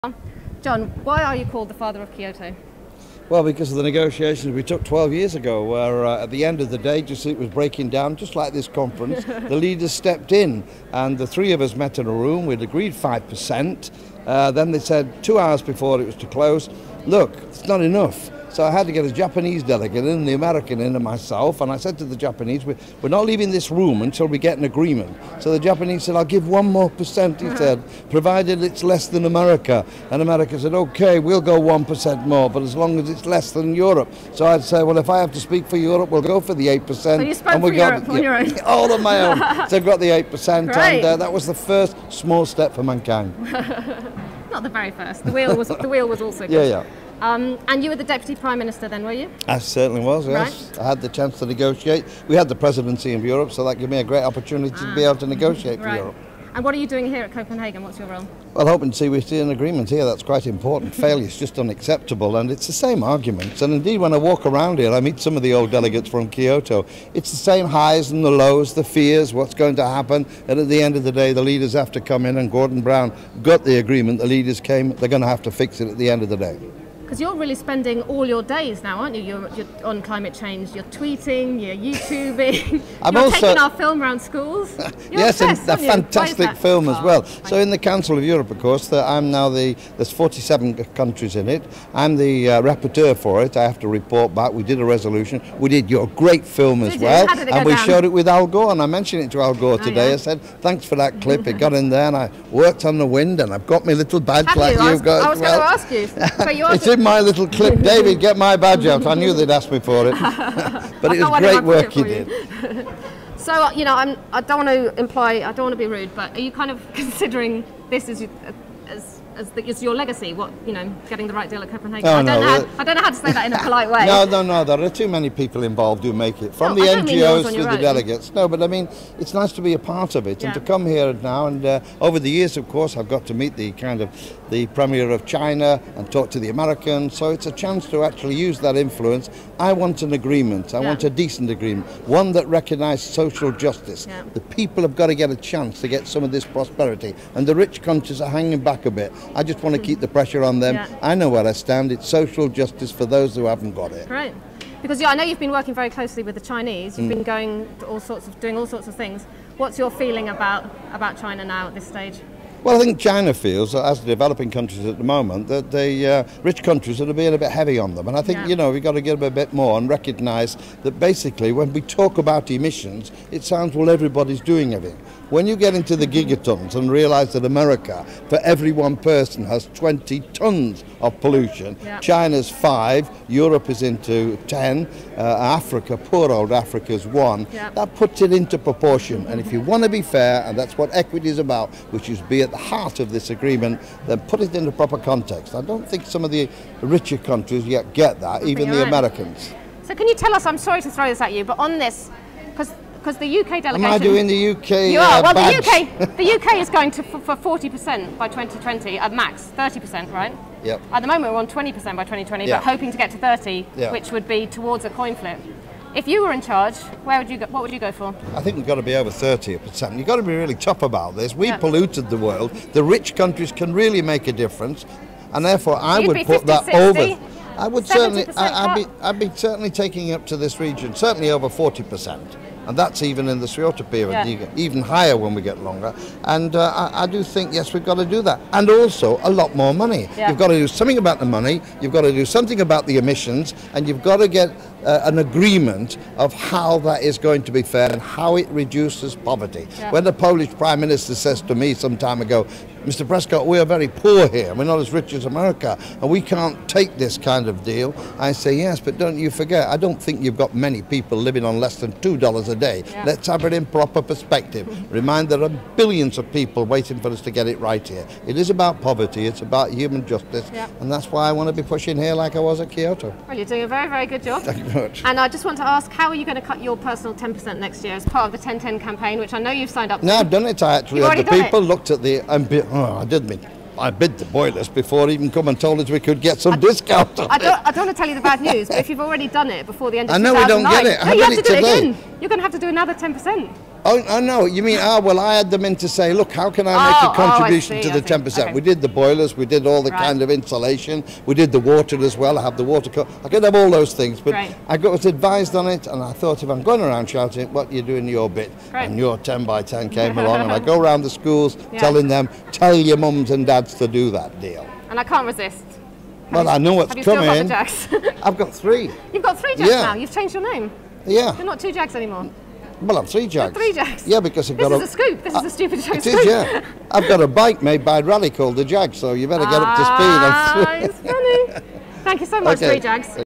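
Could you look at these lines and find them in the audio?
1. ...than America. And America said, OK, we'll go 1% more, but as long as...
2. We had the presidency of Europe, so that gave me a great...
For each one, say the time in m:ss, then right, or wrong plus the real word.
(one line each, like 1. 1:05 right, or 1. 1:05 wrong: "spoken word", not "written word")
1. 0:29 right
2. 0:52 right.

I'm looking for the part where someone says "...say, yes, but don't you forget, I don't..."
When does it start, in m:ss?
4:18.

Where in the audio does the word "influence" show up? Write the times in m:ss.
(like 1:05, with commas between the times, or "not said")
2:18.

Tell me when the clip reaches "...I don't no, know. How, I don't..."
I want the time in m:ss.
2:02.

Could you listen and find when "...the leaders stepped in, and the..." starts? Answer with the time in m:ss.
0:09.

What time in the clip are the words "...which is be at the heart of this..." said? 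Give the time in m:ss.
3:11.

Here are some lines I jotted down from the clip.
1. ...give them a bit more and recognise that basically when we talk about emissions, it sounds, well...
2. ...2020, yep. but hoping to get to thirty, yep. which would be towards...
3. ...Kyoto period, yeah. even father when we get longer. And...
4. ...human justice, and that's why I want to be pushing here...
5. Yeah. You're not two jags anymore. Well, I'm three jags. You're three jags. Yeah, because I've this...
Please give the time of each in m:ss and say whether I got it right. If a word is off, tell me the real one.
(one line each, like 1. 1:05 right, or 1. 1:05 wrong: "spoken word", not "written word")
1. 2:49 right
2. 3:32 right
3. 3:53 wrong: "higher", not "father"
4. 4:29 right
5. 5:21 right.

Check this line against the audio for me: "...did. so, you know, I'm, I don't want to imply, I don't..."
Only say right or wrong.
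right.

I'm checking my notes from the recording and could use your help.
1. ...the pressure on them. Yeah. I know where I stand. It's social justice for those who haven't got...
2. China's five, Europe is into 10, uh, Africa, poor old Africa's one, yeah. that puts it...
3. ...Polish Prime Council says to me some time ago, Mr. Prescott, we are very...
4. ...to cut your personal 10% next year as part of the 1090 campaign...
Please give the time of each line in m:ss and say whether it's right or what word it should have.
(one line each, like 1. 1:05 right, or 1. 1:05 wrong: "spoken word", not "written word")
1. 2:29 right
2. 3:01 right
3. 4:10 wrong: "Minister", not "Council"
4. 4:36 wrong: "1010", not "1090".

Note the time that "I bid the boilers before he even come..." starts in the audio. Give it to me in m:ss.
4:43.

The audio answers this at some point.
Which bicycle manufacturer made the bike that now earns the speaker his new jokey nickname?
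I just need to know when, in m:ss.
5:28.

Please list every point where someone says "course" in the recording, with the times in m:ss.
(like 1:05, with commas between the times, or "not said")
1:28, 2:12.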